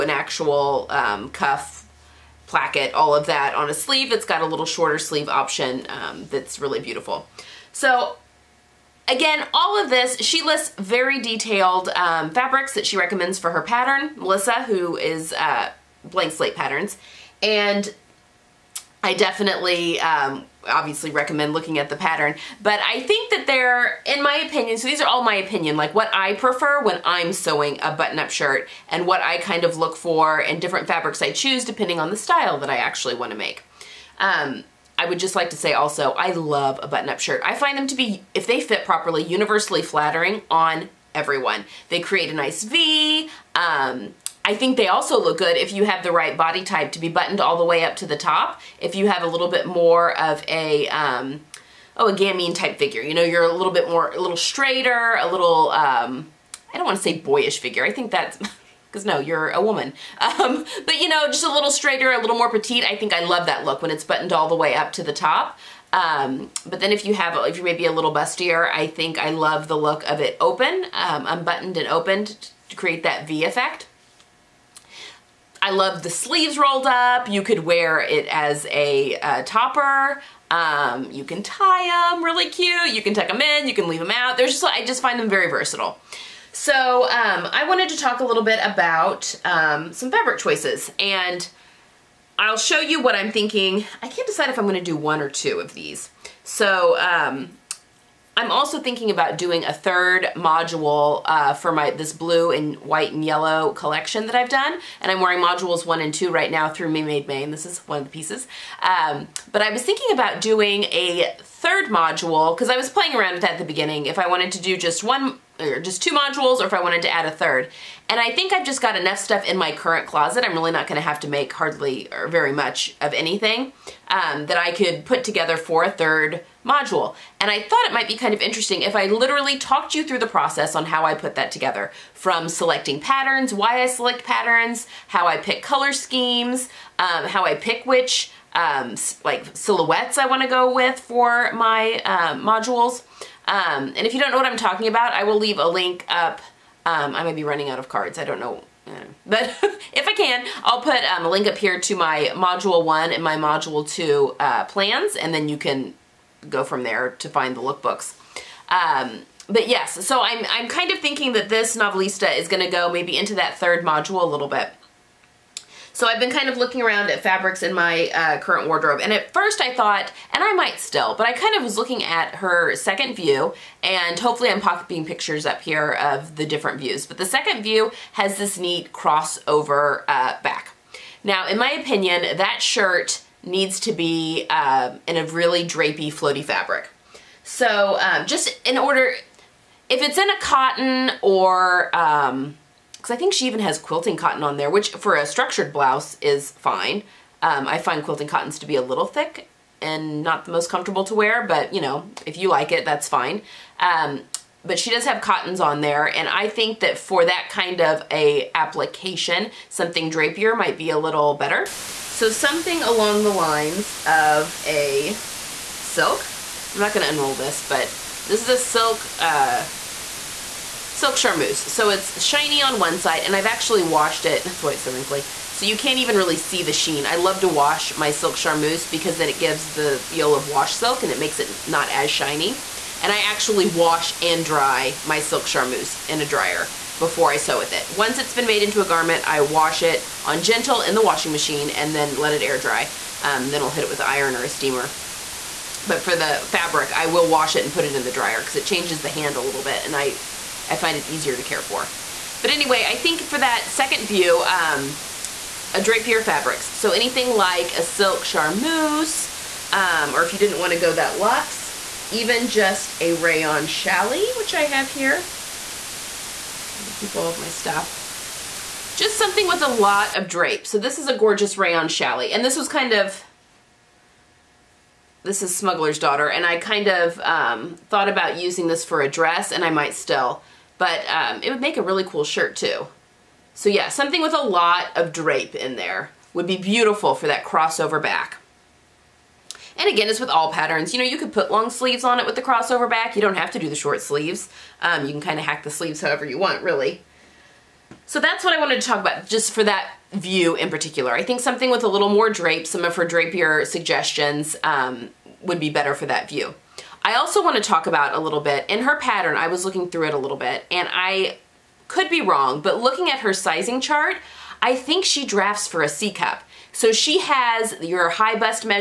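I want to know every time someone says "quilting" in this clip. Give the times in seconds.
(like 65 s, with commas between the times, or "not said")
193 s, 198 s.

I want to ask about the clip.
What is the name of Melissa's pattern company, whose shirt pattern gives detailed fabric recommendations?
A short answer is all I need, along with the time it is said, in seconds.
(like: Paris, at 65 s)
Blank Slate Patterns, at 16 s.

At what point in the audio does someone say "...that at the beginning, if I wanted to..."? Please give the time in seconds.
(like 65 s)
113 s.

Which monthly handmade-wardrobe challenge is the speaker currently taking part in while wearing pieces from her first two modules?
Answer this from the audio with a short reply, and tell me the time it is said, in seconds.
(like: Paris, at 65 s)
Me Made May, at 106 s.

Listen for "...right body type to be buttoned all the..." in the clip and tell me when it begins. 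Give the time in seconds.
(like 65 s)
46 s.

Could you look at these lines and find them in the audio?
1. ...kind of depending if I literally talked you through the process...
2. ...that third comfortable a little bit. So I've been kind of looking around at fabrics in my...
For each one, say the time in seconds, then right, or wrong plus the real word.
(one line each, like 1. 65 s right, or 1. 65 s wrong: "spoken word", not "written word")
1. 128 s wrong: "interesting", not "depending"
2. 163 s wrong: "module", not "comfortable".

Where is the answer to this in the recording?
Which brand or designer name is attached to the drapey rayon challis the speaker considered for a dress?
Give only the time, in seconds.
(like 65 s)
275 s.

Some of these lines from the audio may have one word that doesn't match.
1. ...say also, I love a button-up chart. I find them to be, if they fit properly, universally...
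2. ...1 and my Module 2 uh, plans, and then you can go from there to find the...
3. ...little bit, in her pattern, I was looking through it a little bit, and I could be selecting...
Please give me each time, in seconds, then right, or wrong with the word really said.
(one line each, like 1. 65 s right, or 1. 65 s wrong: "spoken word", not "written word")
1. 35 s wrong: "shirt", not "chart"
2. 152 s right
3. 308 s wrong: "wrong", not "selecting".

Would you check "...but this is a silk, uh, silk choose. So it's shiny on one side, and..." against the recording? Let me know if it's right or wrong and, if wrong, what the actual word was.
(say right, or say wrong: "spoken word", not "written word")
wrong: "charmeuse", not "choose".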